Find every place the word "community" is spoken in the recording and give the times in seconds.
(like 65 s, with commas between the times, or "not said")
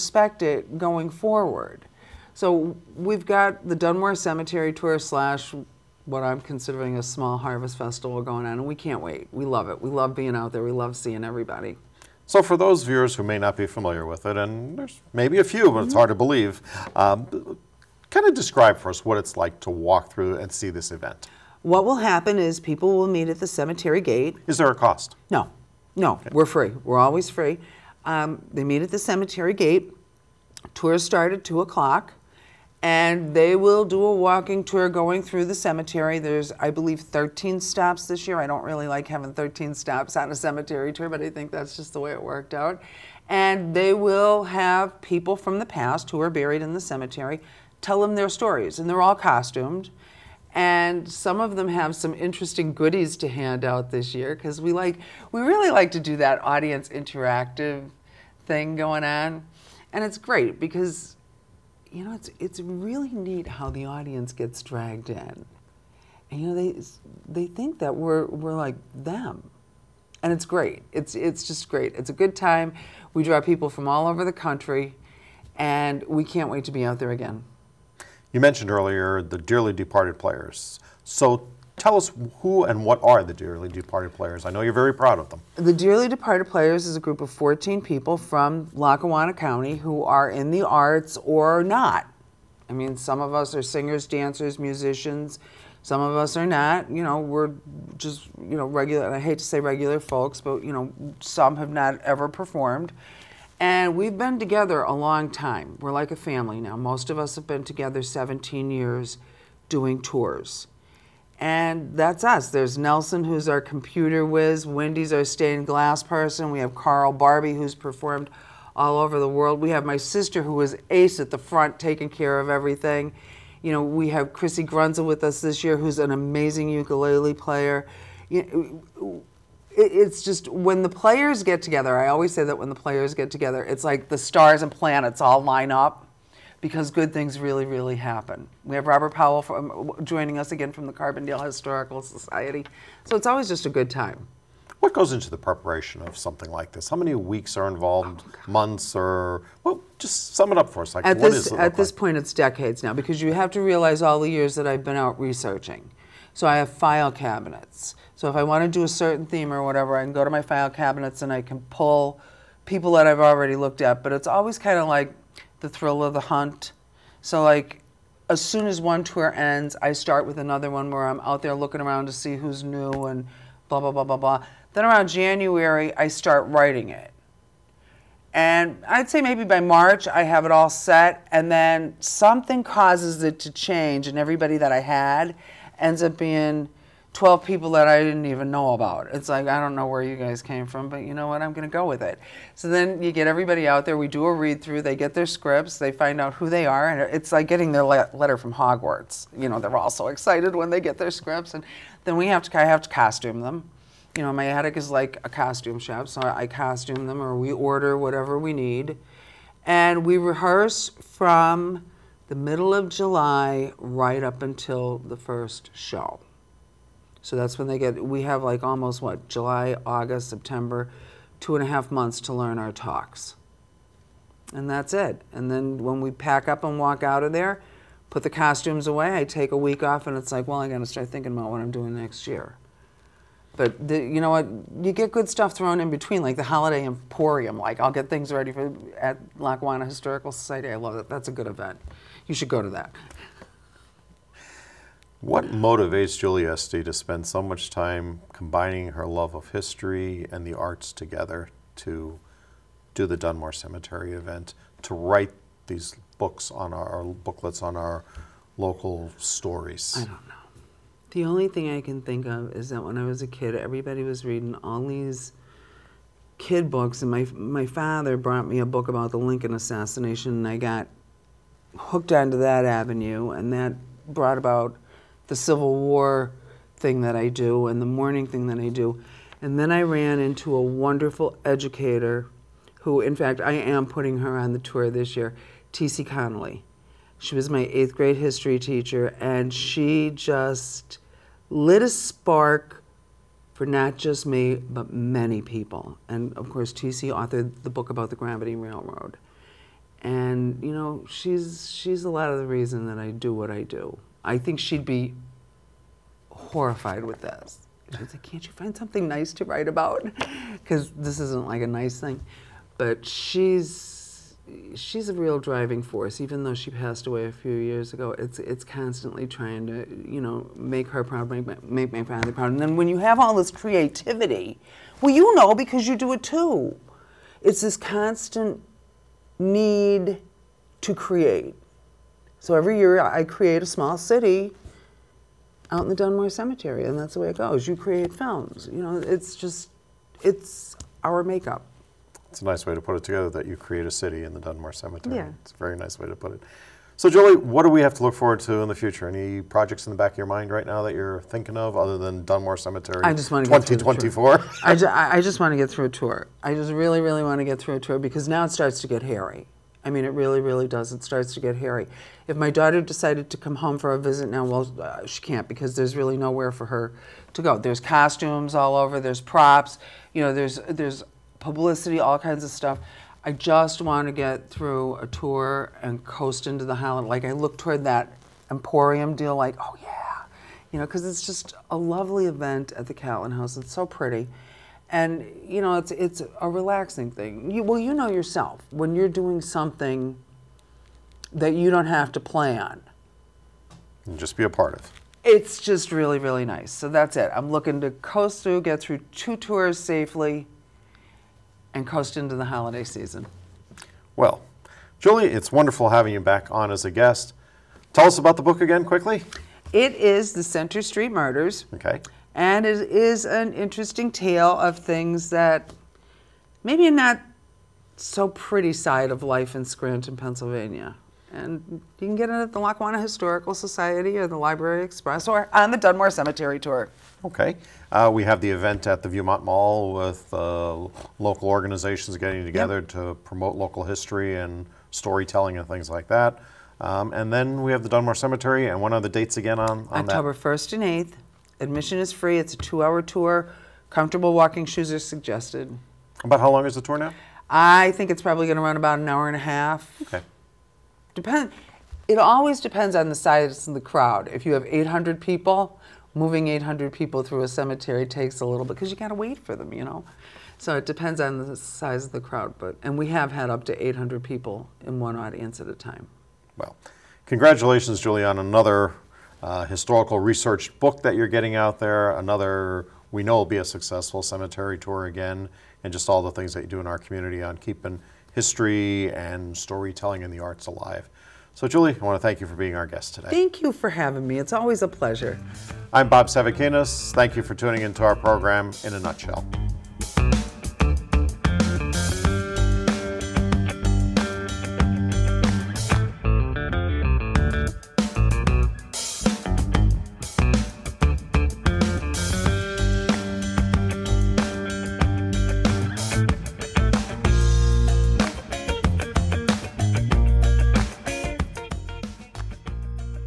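476 s.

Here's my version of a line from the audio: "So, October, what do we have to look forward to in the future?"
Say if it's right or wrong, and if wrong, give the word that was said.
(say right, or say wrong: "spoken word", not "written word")
wrong: "Julie", not "October".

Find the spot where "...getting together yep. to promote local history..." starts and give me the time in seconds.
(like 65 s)
432 s.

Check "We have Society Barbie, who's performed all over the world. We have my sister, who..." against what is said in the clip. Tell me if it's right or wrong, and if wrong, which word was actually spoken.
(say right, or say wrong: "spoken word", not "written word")
wrong: "Carl", not "Society".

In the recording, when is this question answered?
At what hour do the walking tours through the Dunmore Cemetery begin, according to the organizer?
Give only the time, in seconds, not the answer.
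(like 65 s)
31 s.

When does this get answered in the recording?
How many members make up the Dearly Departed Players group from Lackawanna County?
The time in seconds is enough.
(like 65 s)
87 s.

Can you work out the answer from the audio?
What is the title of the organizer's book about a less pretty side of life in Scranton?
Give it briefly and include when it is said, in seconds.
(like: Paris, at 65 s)
The Center Street Murders, at 410 s.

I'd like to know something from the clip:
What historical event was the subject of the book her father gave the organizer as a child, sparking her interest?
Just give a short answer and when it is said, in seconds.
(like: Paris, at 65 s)
Lincoln assassination, at 269 s.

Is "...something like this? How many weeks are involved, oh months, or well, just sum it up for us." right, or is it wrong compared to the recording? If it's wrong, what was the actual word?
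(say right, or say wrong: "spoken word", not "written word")
right.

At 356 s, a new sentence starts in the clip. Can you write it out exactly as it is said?
I just really, really want to get through a tour because now it starts to get hairy.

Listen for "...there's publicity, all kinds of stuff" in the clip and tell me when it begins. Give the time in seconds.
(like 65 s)
370 s.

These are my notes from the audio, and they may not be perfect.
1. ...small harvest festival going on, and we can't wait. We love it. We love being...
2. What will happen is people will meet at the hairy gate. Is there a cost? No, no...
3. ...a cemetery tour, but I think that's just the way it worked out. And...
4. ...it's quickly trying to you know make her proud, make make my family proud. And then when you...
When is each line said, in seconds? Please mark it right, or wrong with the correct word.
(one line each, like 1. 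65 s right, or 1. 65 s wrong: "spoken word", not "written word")
1. 7 s right
2. 21 s wrong: "cemetery", not "hairy"
3. 40 s right
4. 318 s wrong: "constantly", not "quickly".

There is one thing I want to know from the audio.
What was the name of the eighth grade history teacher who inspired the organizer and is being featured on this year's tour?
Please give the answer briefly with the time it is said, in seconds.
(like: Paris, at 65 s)
T.C. Connolly, at 285 s.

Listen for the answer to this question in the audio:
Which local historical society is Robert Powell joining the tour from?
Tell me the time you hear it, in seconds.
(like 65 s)
140 s.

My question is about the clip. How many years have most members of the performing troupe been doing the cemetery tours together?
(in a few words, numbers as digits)
17.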